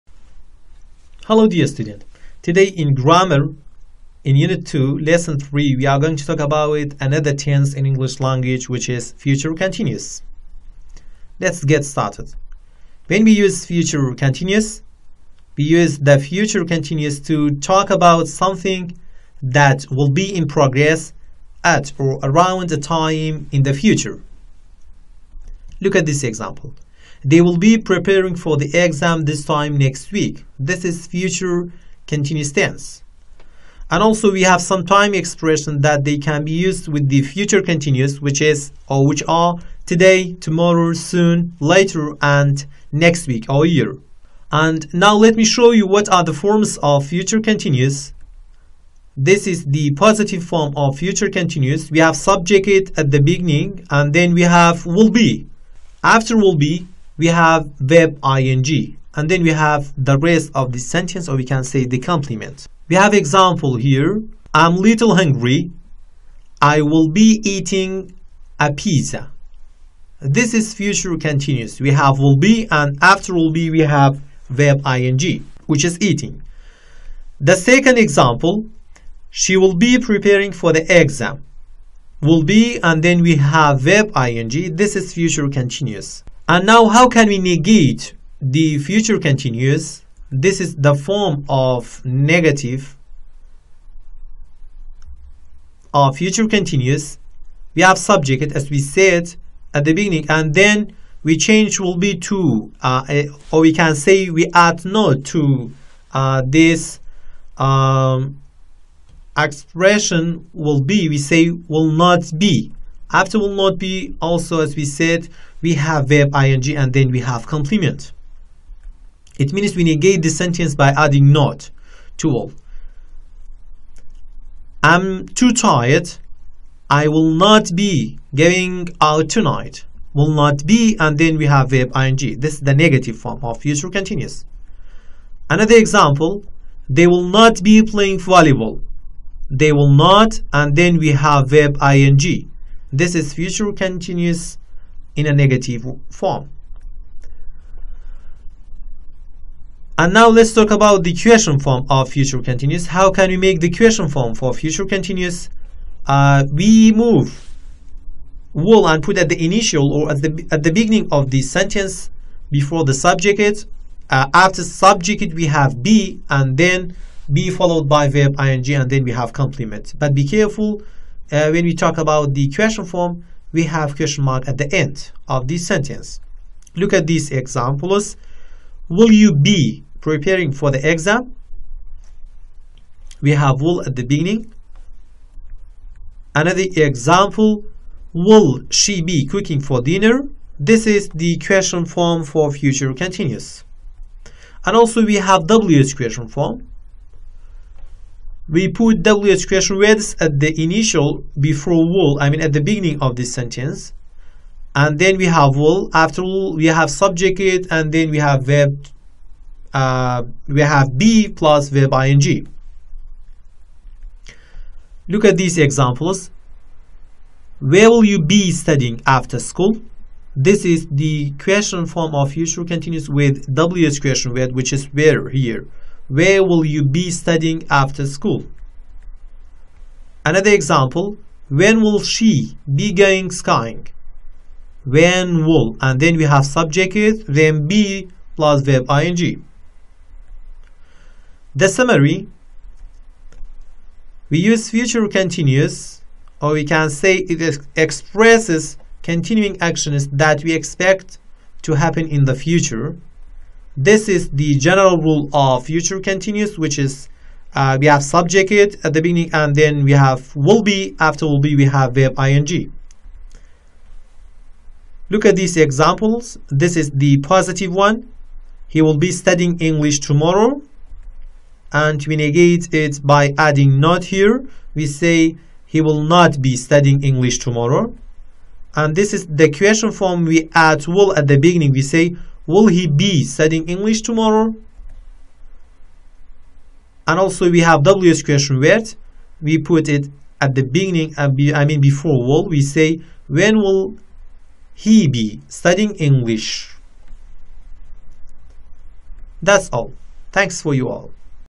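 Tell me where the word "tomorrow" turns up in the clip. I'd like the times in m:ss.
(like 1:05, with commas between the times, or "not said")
0:40, 4:29, 4:37, 4:44.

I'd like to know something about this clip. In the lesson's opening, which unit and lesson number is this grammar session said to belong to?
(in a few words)
Unit 2, lesson 3.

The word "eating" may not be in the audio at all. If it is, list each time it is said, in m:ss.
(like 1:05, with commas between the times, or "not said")
1:07, 1:16.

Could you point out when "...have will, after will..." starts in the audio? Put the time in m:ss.
3:25.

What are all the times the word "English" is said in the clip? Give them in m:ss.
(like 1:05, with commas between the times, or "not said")
0:07, 4:29, 4:37, 4:43, 4:55.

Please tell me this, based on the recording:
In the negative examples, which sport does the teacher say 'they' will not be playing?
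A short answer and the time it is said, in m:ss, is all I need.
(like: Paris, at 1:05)
volleyball, at 2:18.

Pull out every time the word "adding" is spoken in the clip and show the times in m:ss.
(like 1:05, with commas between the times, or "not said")
2:00, 4:33.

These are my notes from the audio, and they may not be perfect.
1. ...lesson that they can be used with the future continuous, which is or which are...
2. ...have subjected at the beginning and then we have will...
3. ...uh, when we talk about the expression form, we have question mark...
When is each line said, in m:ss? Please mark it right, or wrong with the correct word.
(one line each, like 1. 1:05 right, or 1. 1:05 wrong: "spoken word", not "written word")
1. 0:35 wrong: "expression", not "lesson"
2. 0:51 right
3. 2:51 wrong: "question", not "expression".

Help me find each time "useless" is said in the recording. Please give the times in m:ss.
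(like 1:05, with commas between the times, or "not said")
not said.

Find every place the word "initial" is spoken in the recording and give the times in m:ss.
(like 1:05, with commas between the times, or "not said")
2:39, 3:20.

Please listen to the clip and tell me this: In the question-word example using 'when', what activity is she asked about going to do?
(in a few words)
skiing.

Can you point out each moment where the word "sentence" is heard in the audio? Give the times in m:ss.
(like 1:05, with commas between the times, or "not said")
1:00, 2:00, 2:41, 2:55, 3:23.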